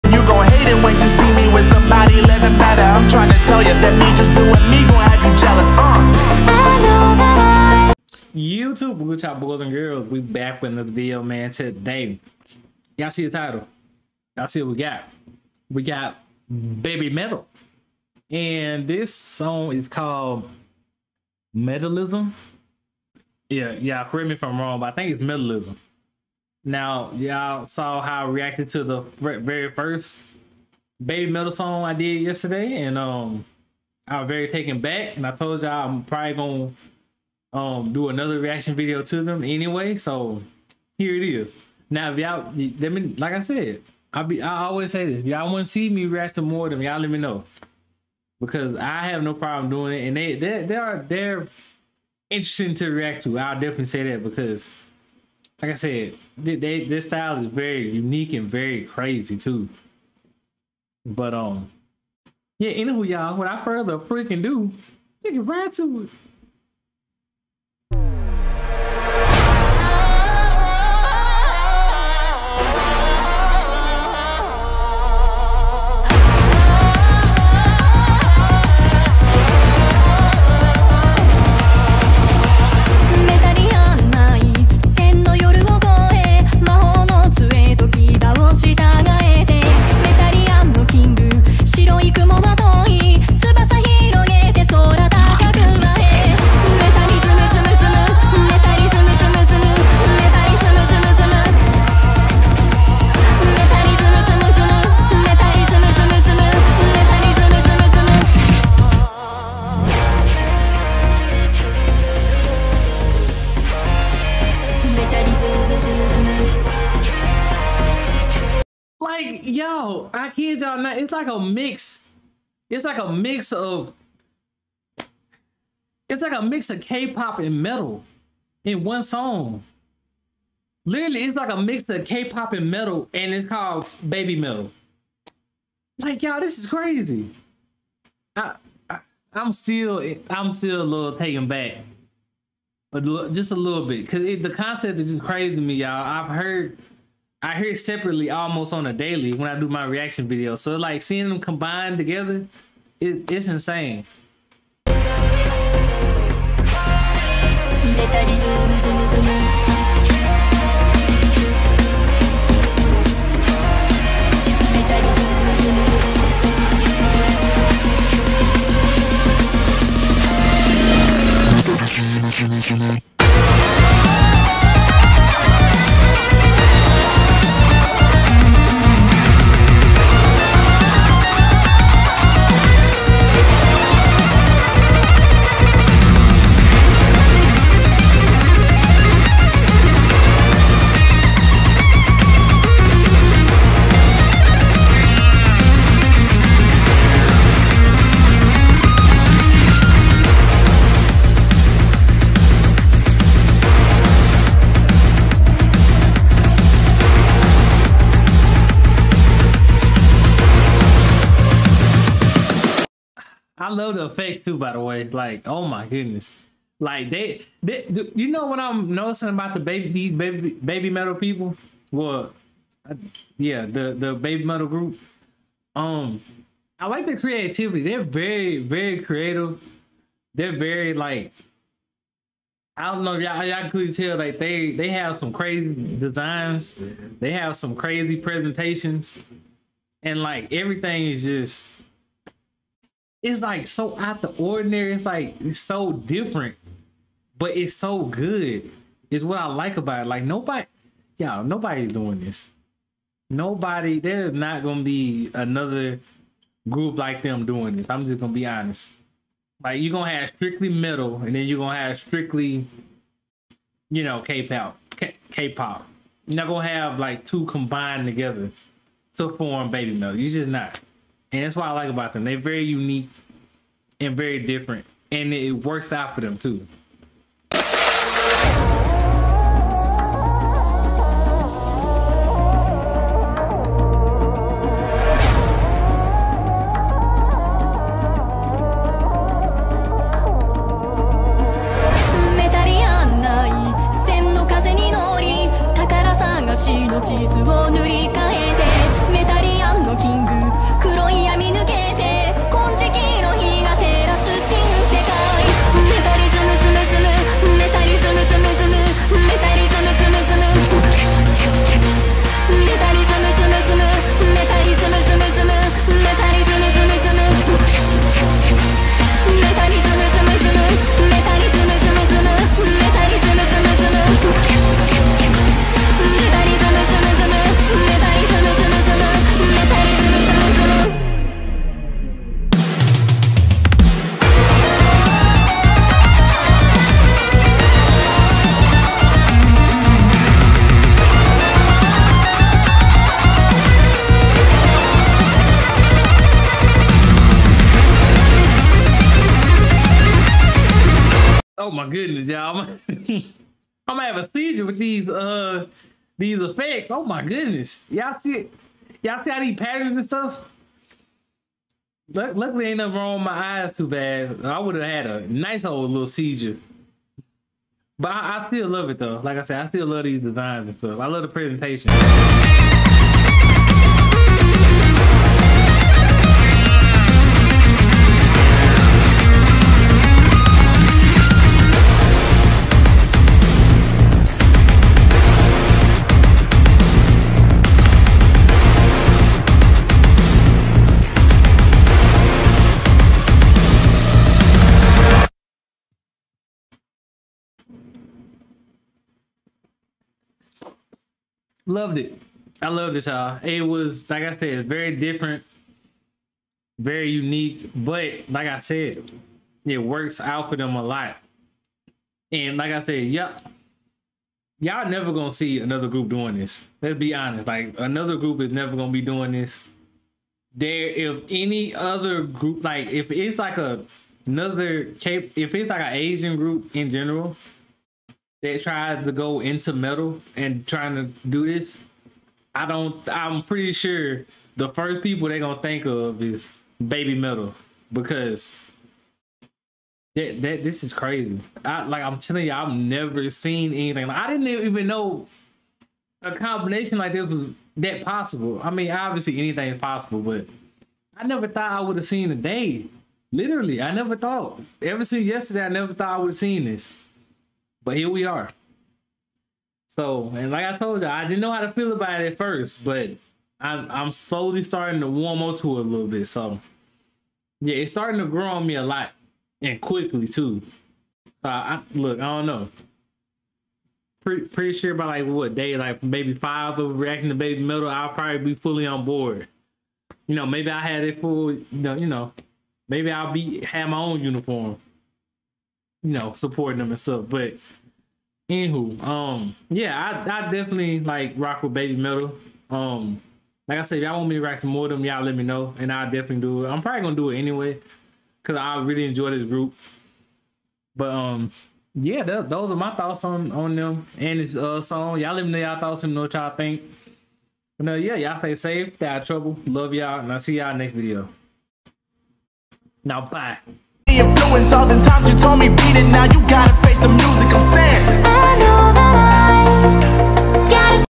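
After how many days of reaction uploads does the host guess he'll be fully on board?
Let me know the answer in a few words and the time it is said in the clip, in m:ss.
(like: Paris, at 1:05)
5, at 7:56.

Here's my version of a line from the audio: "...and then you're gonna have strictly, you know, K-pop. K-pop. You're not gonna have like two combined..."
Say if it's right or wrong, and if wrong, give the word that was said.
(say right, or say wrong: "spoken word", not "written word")
right.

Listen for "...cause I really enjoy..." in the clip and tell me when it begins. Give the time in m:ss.
8:18.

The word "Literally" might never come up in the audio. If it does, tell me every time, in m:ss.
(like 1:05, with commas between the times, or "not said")
2:10, 7:33.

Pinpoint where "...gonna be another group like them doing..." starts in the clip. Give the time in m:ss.
4:14.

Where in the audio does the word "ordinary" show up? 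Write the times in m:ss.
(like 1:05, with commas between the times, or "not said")
4:04.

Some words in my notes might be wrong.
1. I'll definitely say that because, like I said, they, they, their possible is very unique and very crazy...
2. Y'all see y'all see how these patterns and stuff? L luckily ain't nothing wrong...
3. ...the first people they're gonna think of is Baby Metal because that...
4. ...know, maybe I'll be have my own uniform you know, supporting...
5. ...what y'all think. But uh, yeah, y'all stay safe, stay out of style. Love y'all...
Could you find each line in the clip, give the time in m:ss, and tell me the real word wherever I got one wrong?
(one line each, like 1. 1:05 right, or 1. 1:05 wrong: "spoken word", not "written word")
1. 0:53 wrong: "style", not "possible"
2. 5:57 right
3. 7:14 right
4. 8:02 right
5. 8:26 wrong: "trouble", not "style".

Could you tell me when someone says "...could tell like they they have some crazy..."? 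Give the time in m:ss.
3:53.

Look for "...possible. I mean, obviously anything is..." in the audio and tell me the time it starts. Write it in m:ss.
7:28.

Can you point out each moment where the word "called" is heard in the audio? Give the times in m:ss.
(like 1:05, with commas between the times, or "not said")
0:19, 2:13.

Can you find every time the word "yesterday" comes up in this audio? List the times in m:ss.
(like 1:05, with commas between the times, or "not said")
0:32, 7:35.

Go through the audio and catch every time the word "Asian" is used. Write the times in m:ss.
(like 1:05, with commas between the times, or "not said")
7:05.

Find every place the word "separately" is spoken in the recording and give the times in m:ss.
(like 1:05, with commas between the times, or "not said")
2:27.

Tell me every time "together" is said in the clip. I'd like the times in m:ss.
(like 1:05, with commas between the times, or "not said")
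2:31, 4:28.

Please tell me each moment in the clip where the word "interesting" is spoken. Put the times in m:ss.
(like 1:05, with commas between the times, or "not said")
0:52.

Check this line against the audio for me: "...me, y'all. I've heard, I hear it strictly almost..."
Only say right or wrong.
wrong.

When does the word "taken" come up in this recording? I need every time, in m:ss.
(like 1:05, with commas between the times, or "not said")
0:34, 2:21.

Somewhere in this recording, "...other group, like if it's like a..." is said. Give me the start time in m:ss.
7:01.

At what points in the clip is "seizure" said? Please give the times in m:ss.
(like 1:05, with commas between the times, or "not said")
5:54, 6:06.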